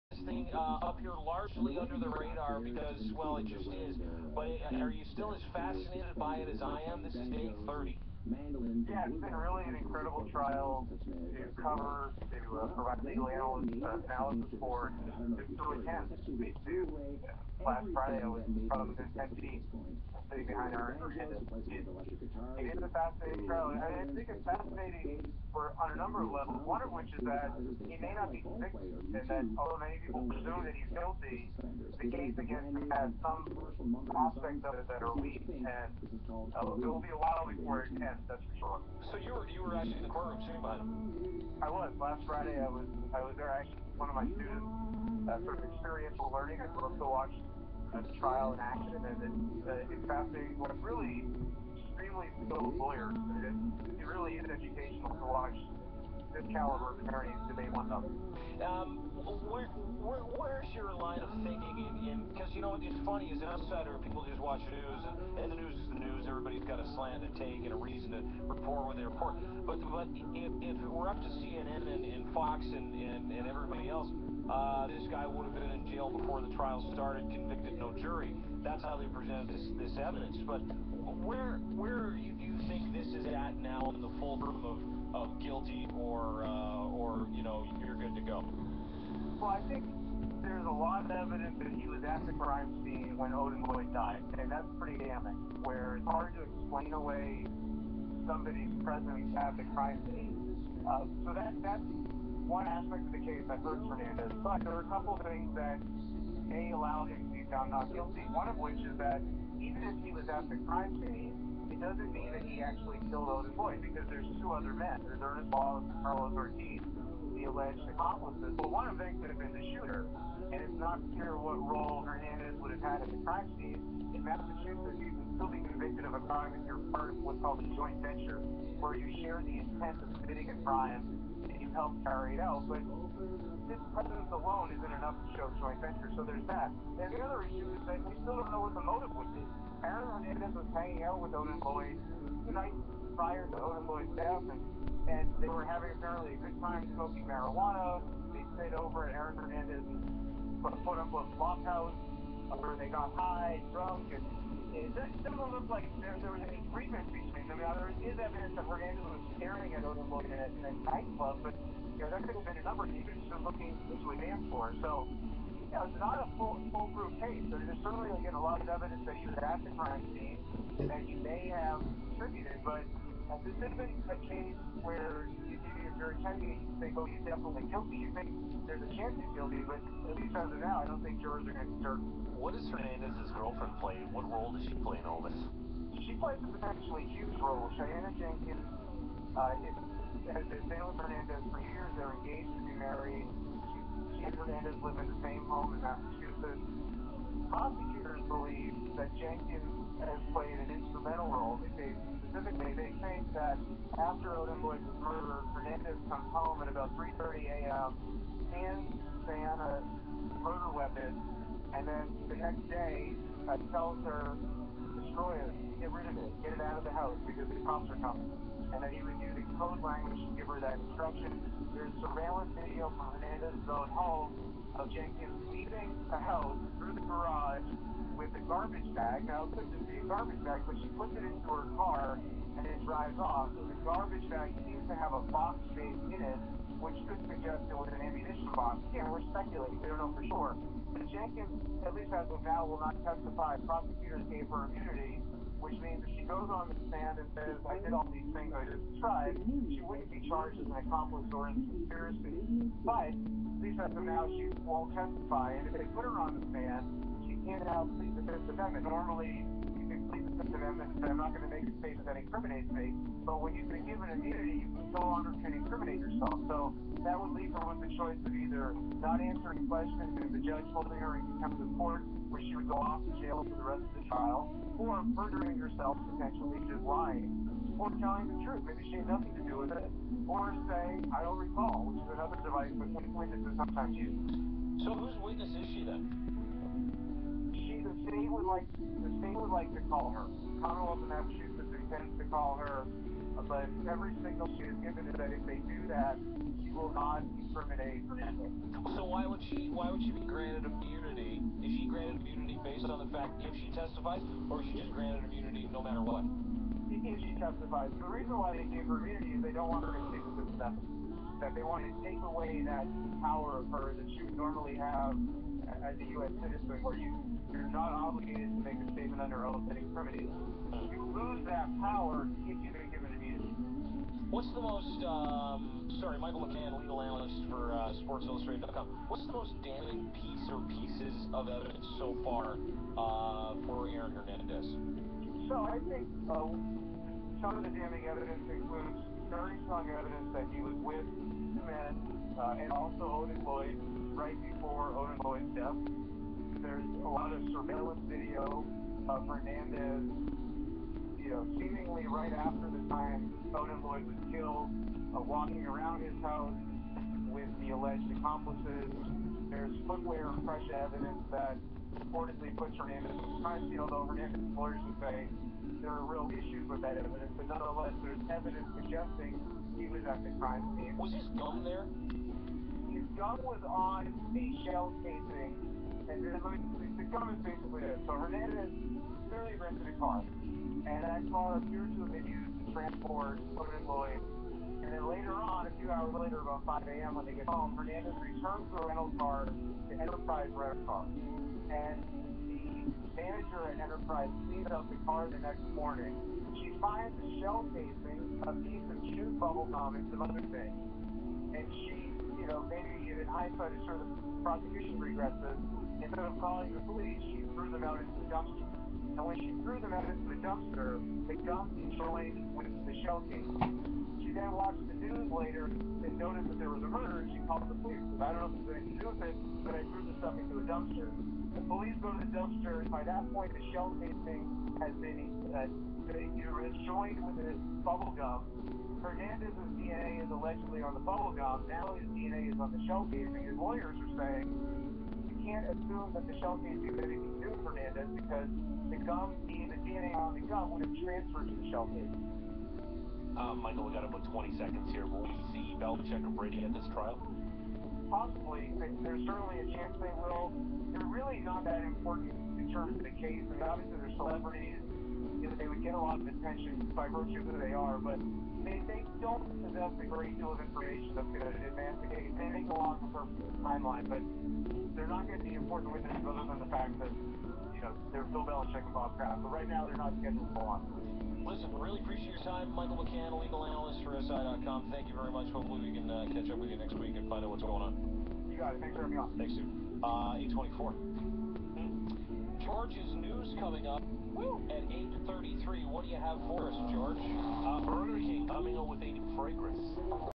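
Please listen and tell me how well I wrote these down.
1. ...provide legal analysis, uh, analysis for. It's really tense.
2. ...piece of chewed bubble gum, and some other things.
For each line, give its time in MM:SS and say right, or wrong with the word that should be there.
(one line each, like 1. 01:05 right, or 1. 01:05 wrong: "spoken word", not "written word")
1. 00:12 right
2. 06:38 right.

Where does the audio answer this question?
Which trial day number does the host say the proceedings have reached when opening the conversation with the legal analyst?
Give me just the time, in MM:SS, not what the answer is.
00:07.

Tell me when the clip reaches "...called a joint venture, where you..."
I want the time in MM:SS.
02:07.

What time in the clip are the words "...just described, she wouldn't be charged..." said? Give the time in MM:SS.
04:08.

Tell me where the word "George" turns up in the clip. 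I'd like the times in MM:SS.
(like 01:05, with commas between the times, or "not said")
08:02, 08:06.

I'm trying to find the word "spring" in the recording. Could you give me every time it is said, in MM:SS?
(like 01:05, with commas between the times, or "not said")
not said.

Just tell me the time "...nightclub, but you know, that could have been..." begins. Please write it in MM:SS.
02:40.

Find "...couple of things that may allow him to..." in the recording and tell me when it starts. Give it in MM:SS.
01:44.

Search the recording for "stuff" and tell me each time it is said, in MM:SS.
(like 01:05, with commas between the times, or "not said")
07:00.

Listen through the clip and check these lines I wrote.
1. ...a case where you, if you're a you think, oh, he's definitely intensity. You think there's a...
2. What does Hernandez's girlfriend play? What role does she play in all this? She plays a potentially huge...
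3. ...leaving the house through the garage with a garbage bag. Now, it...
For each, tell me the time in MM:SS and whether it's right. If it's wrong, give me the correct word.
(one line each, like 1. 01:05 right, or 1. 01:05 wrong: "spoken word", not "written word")
1. 02:54 wrong: "guilty", not "intensity"
2. 03:02 right
3. 03:45 right.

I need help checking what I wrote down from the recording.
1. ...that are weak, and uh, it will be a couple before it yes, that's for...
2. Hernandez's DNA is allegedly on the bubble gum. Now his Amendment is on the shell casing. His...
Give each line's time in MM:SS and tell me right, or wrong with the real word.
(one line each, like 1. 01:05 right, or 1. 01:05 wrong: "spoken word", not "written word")
1. 00:34 wrong: "while", not "couple"
2. 07:09 wrong: "DNA", not "Amendment".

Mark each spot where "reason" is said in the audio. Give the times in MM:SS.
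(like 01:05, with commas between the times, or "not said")
01:07, 05:08.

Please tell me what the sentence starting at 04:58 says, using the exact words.
So why would she why would she be granted immunity?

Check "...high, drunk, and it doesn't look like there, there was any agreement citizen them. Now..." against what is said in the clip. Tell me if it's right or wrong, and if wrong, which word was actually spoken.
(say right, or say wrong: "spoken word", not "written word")
wrong: "between", not "citizen".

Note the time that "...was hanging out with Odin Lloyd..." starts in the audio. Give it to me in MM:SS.
02:20.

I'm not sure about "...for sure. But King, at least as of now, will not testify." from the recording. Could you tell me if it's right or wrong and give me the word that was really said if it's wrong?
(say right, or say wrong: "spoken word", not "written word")
wrong: "Jenkins", not "King".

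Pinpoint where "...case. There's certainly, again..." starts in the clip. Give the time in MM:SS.
02:47.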